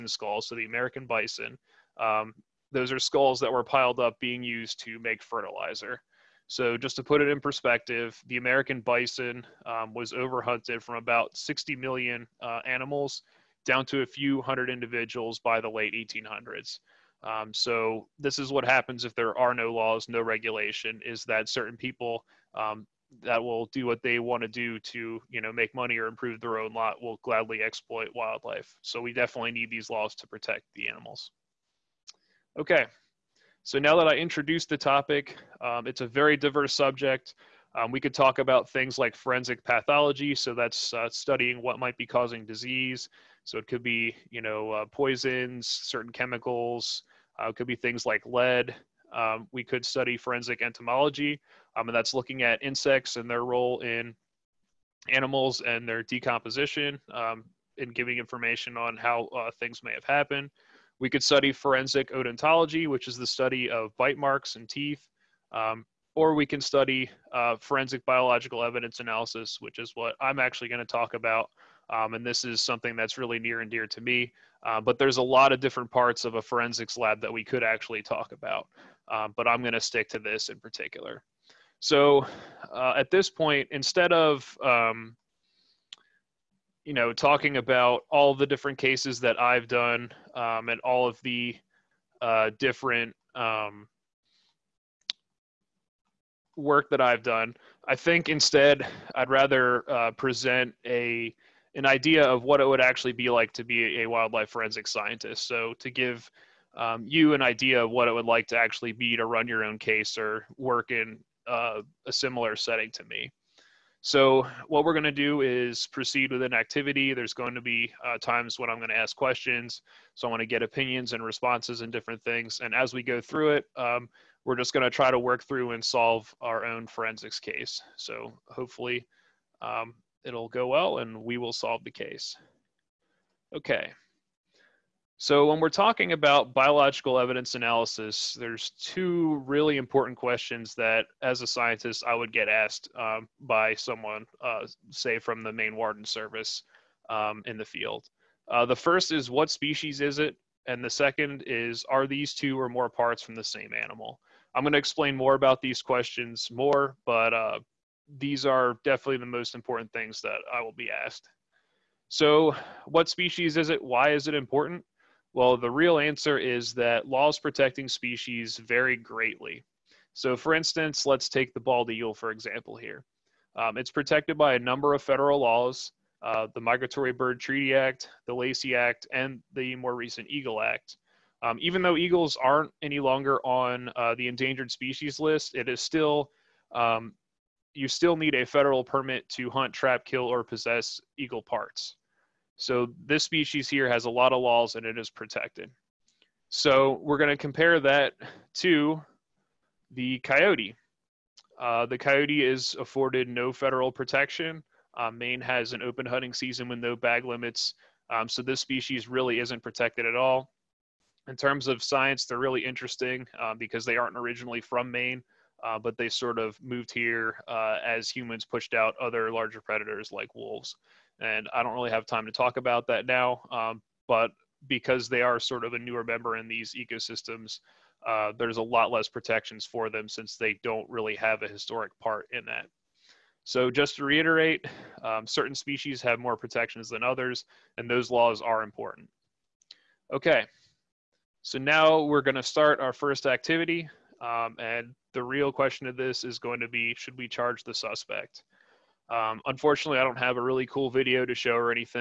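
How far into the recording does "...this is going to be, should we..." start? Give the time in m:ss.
4:05.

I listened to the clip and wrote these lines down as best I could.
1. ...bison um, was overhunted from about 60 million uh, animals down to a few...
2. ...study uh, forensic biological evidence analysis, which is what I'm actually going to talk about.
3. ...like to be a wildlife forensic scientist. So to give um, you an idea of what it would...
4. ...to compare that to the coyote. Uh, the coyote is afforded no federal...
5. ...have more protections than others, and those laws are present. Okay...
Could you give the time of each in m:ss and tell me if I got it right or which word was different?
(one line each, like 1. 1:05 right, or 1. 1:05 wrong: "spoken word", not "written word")
1. 0:08 right
2. 1:06 right
3. 1:43 right
4. 3:17 right
5. 3:56 wrong: "important", not "present".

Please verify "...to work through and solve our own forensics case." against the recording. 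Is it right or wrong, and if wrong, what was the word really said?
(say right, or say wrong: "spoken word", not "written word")
right.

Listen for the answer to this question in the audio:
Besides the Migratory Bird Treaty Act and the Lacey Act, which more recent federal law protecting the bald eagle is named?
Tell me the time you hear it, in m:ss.
3:00.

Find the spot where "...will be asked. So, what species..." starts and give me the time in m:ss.
2:40.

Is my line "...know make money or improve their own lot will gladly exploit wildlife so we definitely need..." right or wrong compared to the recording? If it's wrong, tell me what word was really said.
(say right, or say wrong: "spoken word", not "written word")
right.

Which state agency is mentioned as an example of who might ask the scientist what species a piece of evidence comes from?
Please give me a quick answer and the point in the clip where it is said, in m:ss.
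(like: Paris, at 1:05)
Maine Warden Service, at 2:25.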